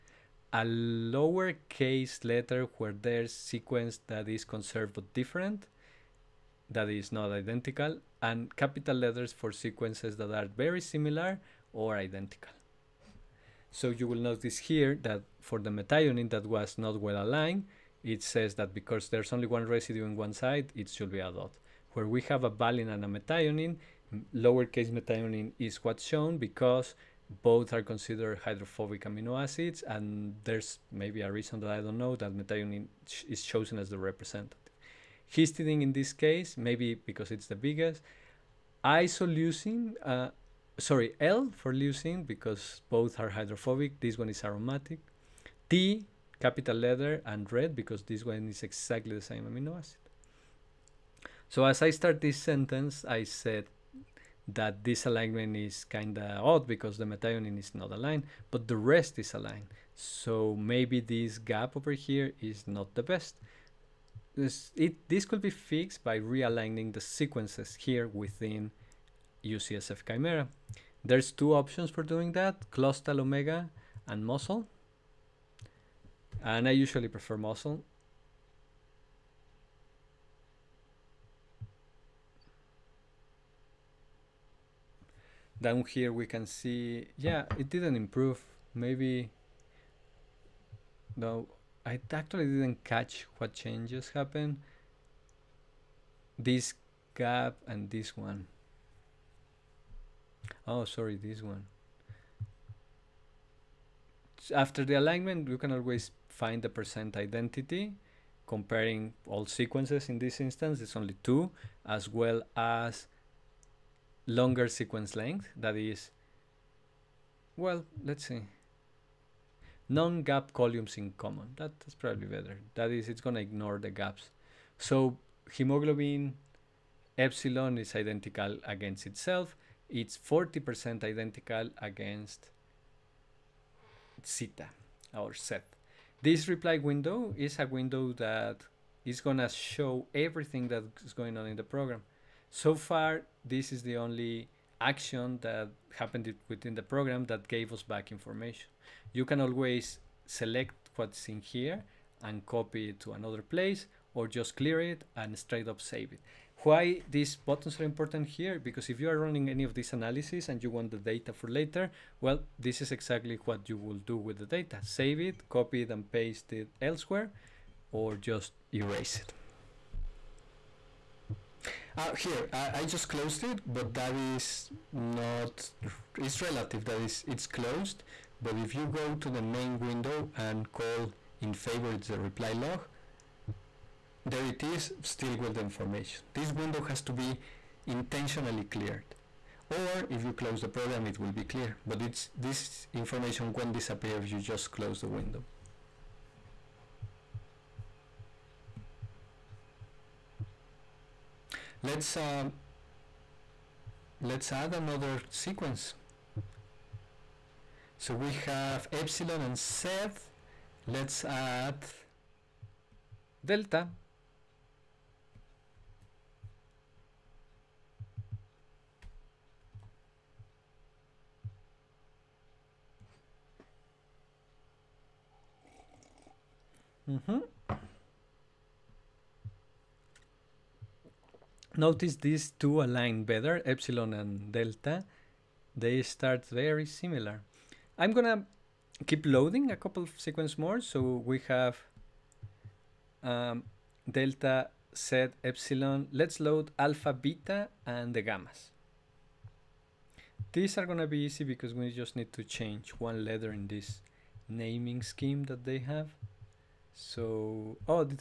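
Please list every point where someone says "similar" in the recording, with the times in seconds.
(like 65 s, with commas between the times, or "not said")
10 s, 236 s.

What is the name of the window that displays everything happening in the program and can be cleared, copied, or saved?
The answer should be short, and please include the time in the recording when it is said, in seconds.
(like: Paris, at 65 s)
Reply log, at 182 s.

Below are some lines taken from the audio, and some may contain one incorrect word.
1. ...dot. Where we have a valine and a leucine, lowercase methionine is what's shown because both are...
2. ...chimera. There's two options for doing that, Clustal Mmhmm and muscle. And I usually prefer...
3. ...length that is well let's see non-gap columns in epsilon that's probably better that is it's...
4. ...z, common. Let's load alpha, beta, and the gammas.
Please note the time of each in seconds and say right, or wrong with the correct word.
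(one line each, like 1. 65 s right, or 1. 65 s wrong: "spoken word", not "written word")
1. 21 s wrong: "methionine", not "leucine"
2. 70 s wrong: "Omega", not "Mmhmm"
3. 115 s wrong: "common", not "epsilon"
4. 244 s wrong: "epsilon", not "common".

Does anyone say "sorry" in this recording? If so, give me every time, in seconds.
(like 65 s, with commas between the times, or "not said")
40 s, 100 s.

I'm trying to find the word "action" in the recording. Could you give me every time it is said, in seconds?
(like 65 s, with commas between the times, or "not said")
144 s.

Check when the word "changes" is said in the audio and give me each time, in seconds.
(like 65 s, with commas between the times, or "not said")
93 s, 252 s.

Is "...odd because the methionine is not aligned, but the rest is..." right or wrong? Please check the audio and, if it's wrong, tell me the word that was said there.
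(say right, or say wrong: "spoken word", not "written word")
right.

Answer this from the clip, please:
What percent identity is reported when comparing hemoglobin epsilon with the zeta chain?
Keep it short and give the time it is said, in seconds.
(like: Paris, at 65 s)
40%, at 130 s.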